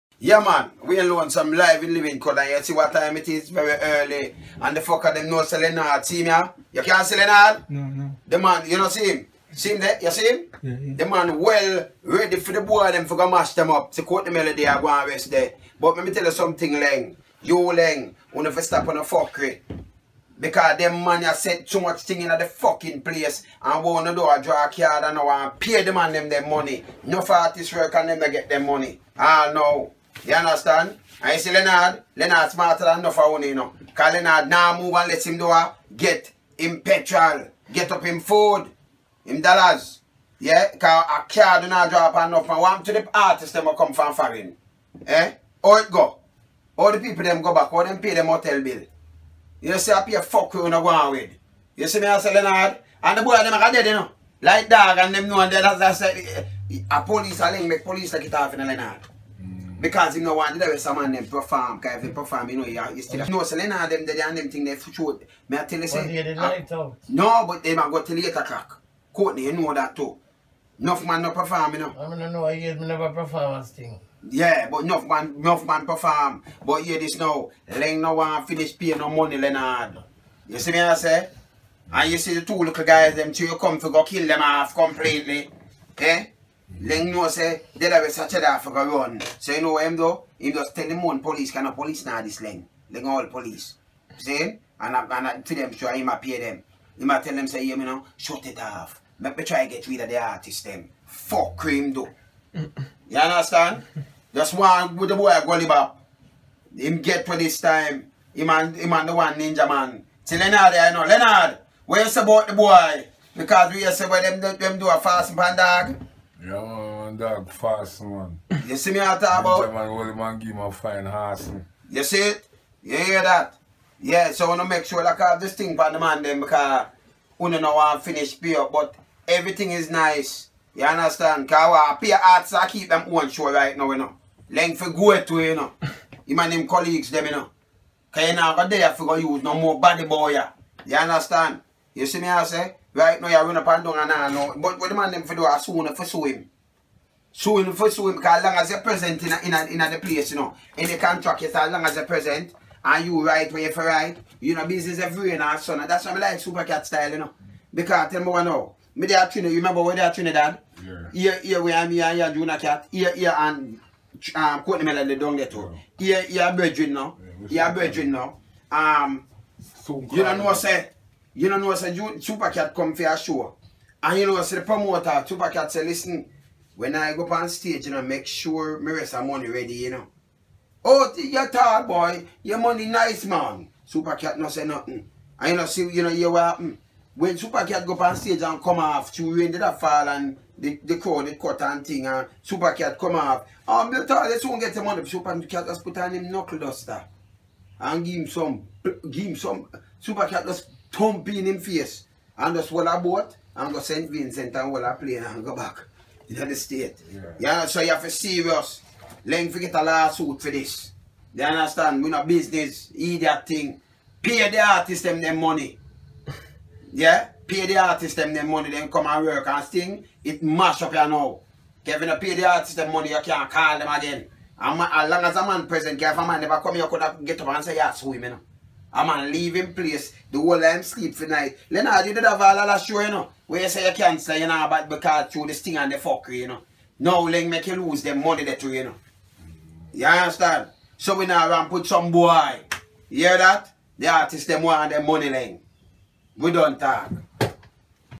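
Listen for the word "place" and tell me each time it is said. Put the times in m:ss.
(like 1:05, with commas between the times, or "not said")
0:23, 2:29, 3:49.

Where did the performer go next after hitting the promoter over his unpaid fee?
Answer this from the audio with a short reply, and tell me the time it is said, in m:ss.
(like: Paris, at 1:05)
St. Vincent, at 3:23.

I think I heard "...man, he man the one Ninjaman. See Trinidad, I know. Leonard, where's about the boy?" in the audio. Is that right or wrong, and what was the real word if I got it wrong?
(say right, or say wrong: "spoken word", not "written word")
wrong: "Leonard", not "Trinidad".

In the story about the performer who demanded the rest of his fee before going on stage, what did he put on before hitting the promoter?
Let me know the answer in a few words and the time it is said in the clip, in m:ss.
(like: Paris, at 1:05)
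knuckle duster, at 3:16.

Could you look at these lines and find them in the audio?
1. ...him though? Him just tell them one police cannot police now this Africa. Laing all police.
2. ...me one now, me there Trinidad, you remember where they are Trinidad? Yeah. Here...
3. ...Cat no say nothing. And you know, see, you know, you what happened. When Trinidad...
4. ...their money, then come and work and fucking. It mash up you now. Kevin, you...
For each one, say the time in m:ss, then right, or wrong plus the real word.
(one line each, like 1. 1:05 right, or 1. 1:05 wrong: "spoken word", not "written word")
1. 1:29 wrong: "Laing", not "Africa"
2. 2:38 right
3. 3:04 wrong: "Super", not "Trinidad"
4. 3:38 wrong: "sting", not "fucking".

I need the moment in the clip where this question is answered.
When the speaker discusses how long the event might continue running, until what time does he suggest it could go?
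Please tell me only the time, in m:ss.
1:08.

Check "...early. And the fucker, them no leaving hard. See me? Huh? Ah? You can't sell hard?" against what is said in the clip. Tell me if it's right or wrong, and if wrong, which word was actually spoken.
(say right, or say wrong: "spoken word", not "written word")
wrong: "selling", not "leaving".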